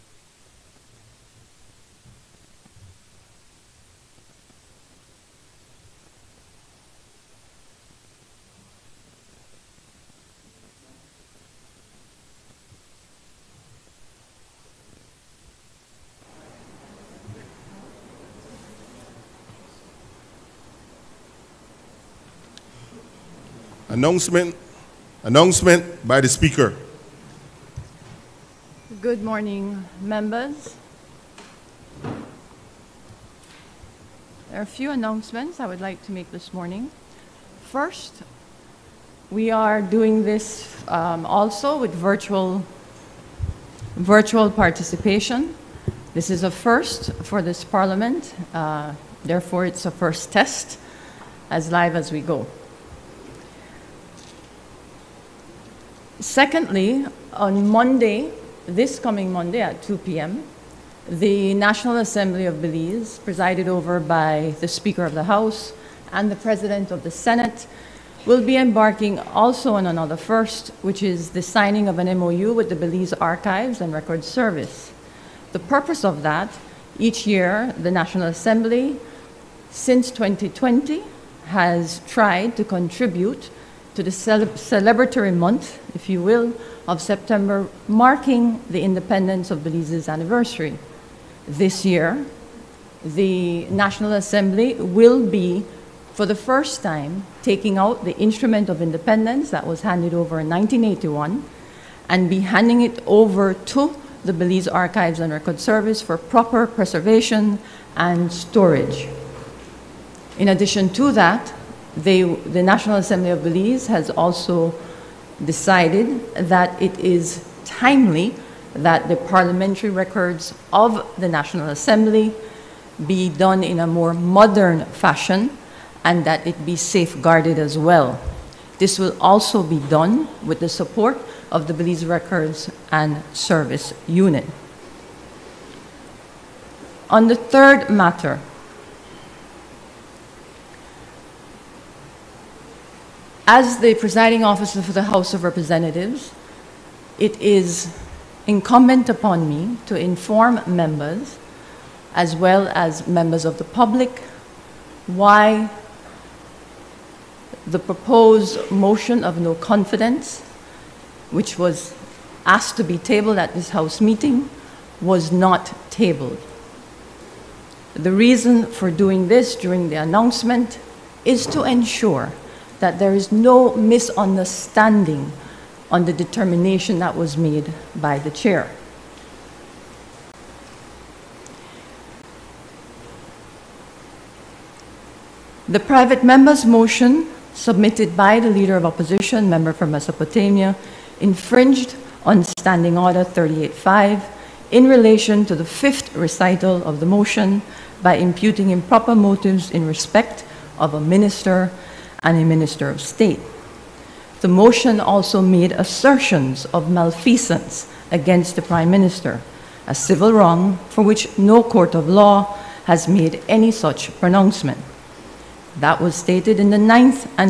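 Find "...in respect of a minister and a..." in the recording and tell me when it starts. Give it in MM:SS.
03:19.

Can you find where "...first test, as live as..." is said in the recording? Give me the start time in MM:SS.
00:49.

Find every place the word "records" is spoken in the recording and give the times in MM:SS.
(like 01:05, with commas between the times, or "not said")
01:13, 01:45, 01:59, 02:12.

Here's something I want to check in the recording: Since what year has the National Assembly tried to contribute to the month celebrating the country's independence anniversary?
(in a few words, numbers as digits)
2020.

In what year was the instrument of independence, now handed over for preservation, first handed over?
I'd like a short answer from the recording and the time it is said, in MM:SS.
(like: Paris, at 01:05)
1981, at 01:40.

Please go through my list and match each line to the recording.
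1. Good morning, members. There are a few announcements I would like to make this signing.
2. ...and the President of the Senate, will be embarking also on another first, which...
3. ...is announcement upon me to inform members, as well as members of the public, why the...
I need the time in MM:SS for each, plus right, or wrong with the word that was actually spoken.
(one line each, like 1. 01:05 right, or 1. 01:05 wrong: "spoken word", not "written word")
1. 00:29 wrong: "morning", not "signing"
2. 01:06 right
3. 02:27 wrong: "incumbent", not "announcement".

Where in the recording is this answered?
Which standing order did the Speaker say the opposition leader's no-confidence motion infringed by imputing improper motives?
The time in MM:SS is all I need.
03:12.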